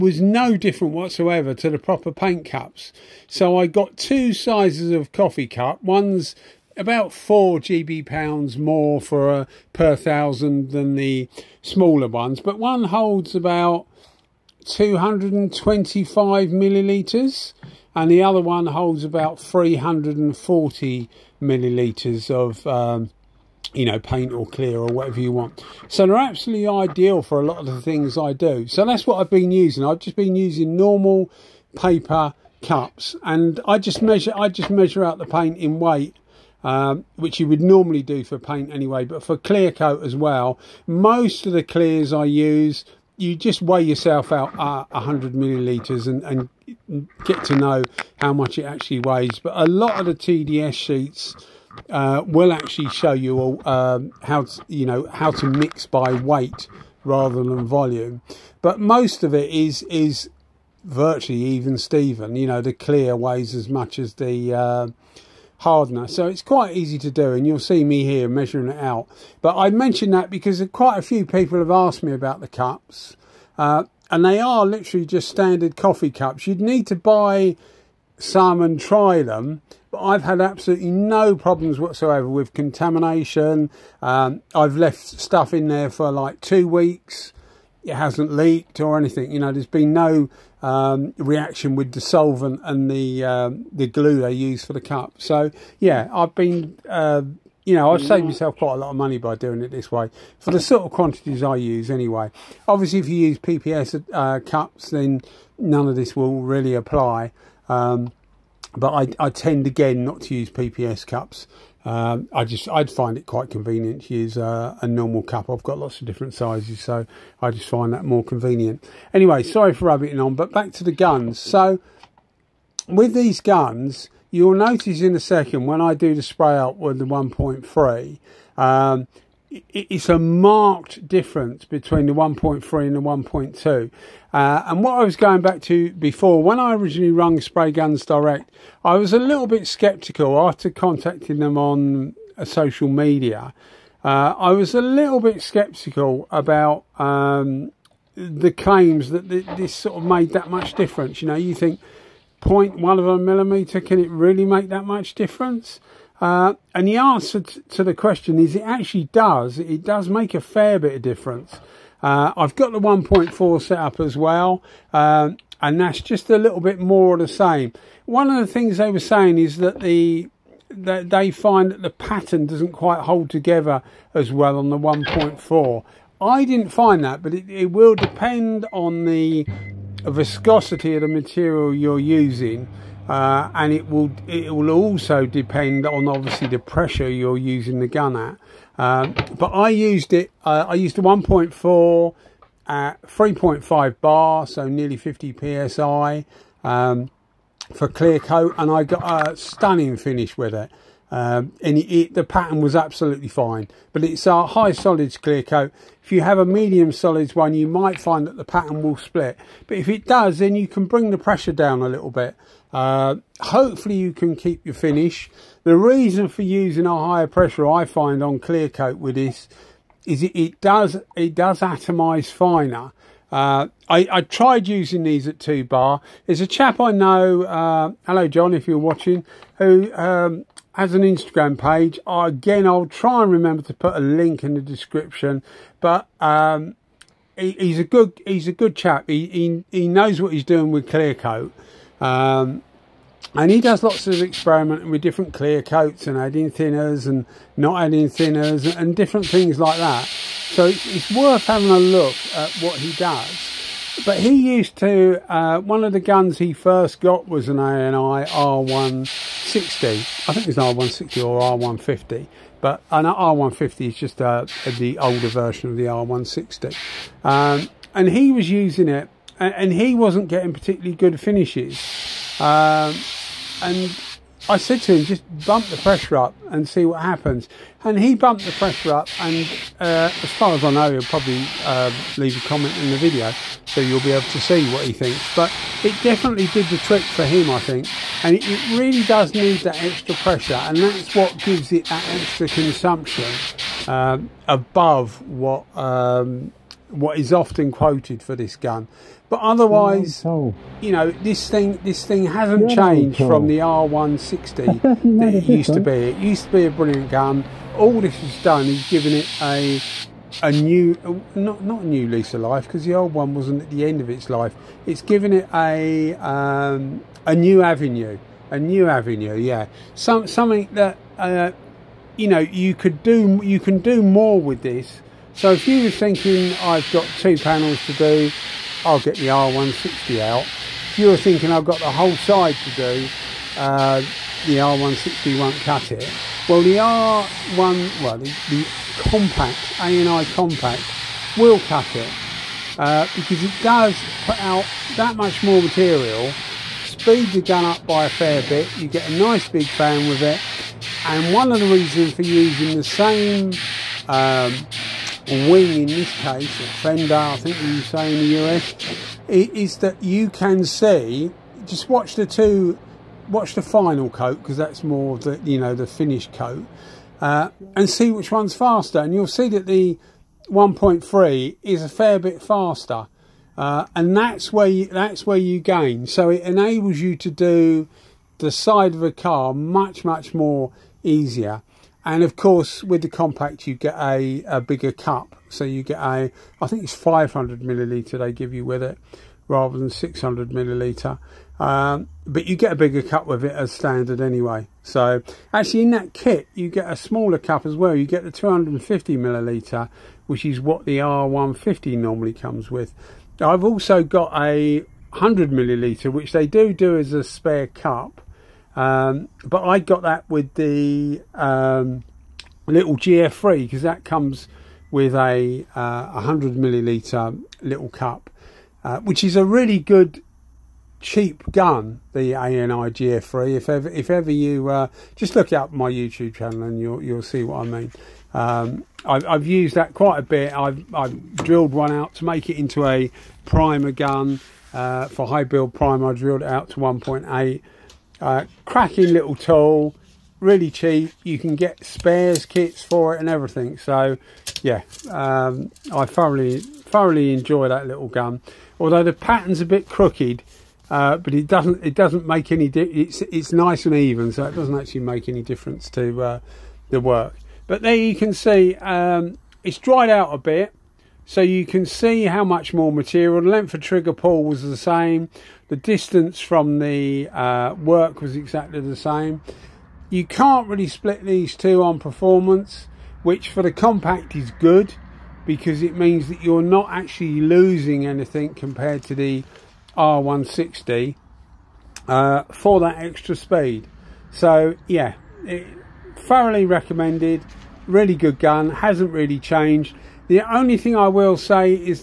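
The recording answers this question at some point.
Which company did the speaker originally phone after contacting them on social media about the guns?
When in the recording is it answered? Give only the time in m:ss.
2:17.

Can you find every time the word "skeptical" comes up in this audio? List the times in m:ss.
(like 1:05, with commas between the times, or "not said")
2:19, 2:25.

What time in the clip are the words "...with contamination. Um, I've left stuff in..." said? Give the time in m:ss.
1:22.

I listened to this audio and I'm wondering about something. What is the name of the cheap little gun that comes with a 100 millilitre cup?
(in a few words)
ANI GF3.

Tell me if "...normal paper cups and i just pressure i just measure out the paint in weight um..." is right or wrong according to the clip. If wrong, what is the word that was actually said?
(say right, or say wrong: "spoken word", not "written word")
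wrong: "measure", not "pressure".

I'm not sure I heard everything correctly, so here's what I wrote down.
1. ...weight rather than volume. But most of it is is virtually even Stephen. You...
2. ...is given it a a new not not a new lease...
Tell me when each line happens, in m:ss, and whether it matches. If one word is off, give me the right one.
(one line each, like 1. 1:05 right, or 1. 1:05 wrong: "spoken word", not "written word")
1. 0:56 right
2. 5:08 right.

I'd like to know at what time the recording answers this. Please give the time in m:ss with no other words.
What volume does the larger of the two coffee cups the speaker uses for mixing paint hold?
0:19.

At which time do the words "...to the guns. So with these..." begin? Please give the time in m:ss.
2:00.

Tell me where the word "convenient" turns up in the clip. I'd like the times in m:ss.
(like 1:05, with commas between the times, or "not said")
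1:53, 1:58.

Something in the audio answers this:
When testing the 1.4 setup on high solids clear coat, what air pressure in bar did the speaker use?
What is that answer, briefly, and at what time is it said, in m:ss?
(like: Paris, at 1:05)
3.5 bar, at 3:13.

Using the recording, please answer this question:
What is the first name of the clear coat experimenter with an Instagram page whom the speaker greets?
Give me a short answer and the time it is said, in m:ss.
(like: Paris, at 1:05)
John, at 3:48.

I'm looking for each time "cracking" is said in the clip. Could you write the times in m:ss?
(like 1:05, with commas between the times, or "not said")
7:18.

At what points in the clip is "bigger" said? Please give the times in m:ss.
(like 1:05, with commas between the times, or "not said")
6:24, 6:32.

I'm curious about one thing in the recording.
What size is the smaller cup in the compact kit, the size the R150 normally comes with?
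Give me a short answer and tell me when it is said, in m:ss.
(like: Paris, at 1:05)
250 millilitres, at 6:38.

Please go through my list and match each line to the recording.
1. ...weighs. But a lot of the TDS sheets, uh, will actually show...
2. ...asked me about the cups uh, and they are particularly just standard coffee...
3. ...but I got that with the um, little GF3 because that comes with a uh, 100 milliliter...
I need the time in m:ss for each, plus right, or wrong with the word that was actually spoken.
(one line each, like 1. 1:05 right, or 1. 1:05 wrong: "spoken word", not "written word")
1. 0:49 right
2. 1:11 wrong: "literally", not "particularly"
3. 6:49 right.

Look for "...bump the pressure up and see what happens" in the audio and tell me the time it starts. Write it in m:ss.
4:35.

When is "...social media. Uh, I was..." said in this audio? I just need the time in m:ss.
2:22.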